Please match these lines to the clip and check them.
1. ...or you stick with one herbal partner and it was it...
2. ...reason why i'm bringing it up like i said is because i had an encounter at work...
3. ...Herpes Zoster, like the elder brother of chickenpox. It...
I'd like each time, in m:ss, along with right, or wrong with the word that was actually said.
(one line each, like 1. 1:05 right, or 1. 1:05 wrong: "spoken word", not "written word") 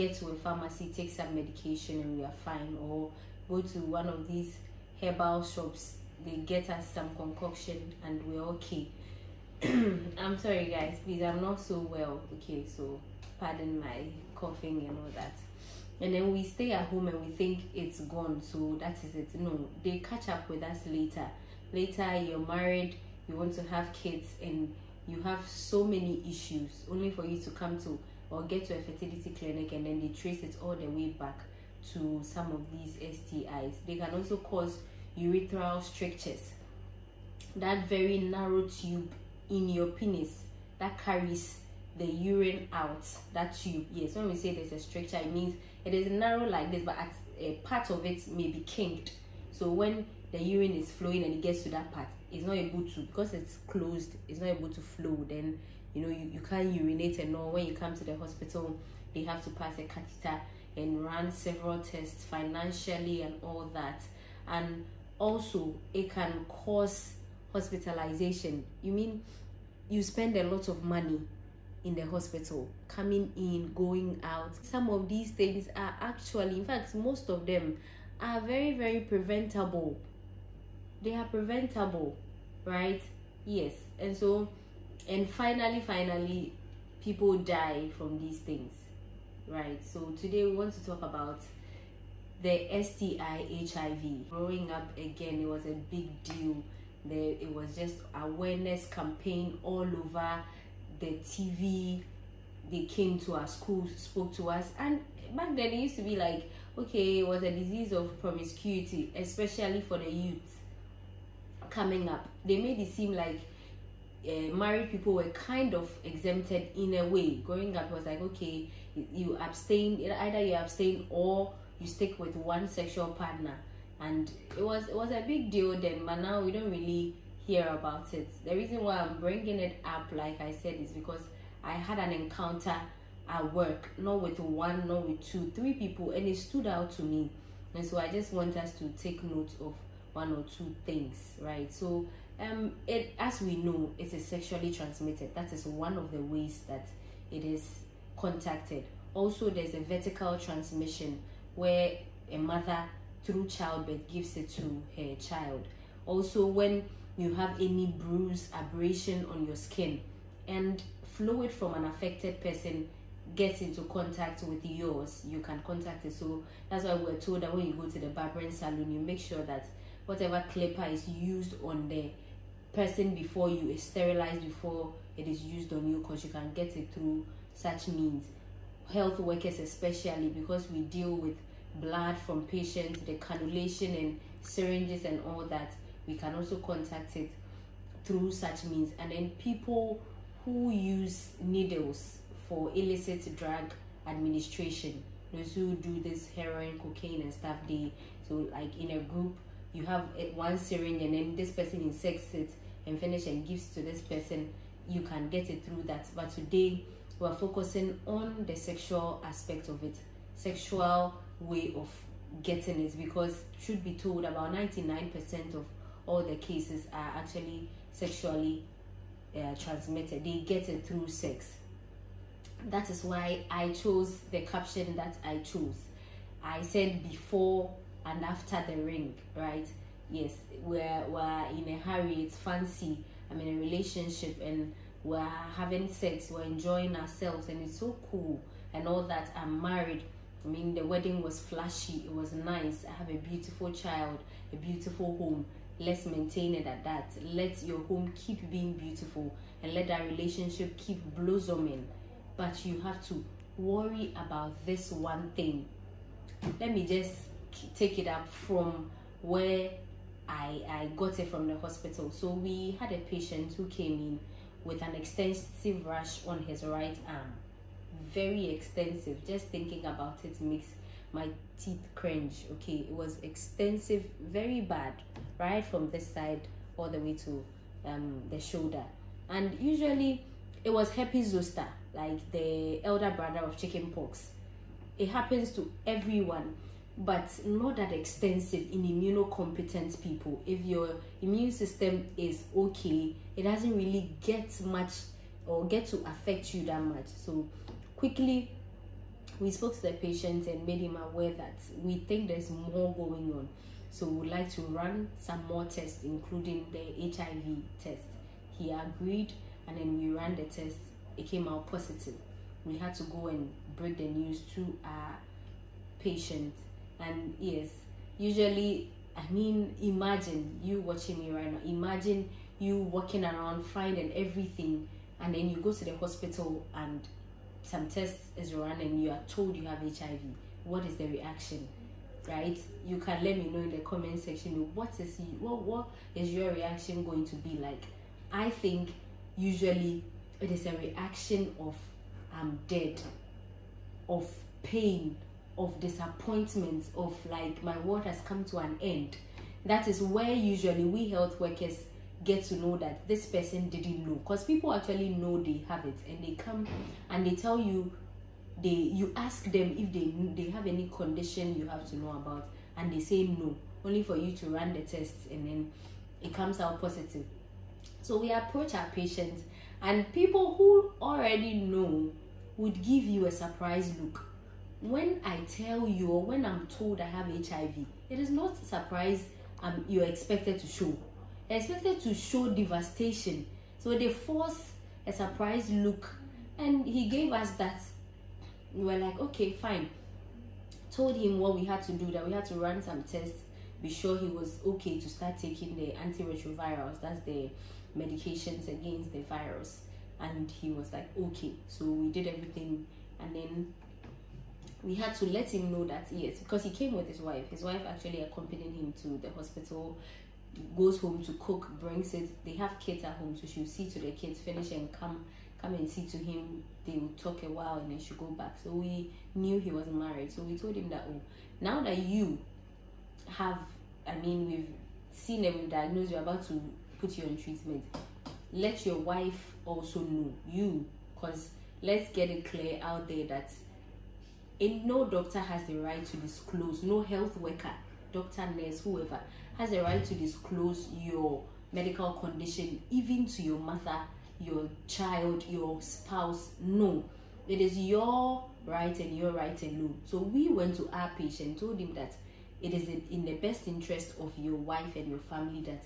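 1. 2:01 wrong: "sexual", not "herbal"
2. 2:08 right
3. 4:40 right.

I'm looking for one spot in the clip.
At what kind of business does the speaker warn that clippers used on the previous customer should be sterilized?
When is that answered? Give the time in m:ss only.
2:48.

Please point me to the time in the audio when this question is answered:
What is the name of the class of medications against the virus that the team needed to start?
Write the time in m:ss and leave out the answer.
6:35.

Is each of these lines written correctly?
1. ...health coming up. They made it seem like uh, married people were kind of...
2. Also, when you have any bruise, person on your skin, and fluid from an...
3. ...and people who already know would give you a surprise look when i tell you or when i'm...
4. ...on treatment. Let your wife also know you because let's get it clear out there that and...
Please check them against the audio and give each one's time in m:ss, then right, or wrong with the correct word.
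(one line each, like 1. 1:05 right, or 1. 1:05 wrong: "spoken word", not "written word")
1. 1:50 wrong: "youth", not "health"
2. 2:36 wrong: "abrasion", not "person"
3. 6:09 right
4. 7:07 right.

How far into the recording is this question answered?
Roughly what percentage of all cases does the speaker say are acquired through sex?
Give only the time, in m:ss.
3:34.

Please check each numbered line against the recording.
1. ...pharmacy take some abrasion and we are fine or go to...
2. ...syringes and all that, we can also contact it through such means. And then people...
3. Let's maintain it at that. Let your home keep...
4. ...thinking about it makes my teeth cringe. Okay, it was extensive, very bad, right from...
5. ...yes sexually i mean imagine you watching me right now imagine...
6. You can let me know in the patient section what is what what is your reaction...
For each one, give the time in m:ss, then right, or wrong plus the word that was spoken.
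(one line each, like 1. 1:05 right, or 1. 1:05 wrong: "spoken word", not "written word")
1. 0:00 wrong: "medication", not "abrasion"
2. 3:04 right
3. 4:05 right
4. 4:29 right
5. 5:17 wrong: "usually", not "sexually"
6. 5:32 wrong: "comment", not "patient".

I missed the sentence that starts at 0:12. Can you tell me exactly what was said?
Okay, so pardon my coughing and all that.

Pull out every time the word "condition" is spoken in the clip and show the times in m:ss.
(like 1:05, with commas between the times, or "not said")
6:00, 7:22.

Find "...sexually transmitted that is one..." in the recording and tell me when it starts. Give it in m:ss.
2:24.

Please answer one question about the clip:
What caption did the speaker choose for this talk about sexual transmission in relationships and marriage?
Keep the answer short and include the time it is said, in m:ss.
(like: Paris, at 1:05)
Before and after the ring, at 3:47.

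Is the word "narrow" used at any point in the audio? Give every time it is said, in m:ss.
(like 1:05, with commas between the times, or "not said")
0:38, 0:46.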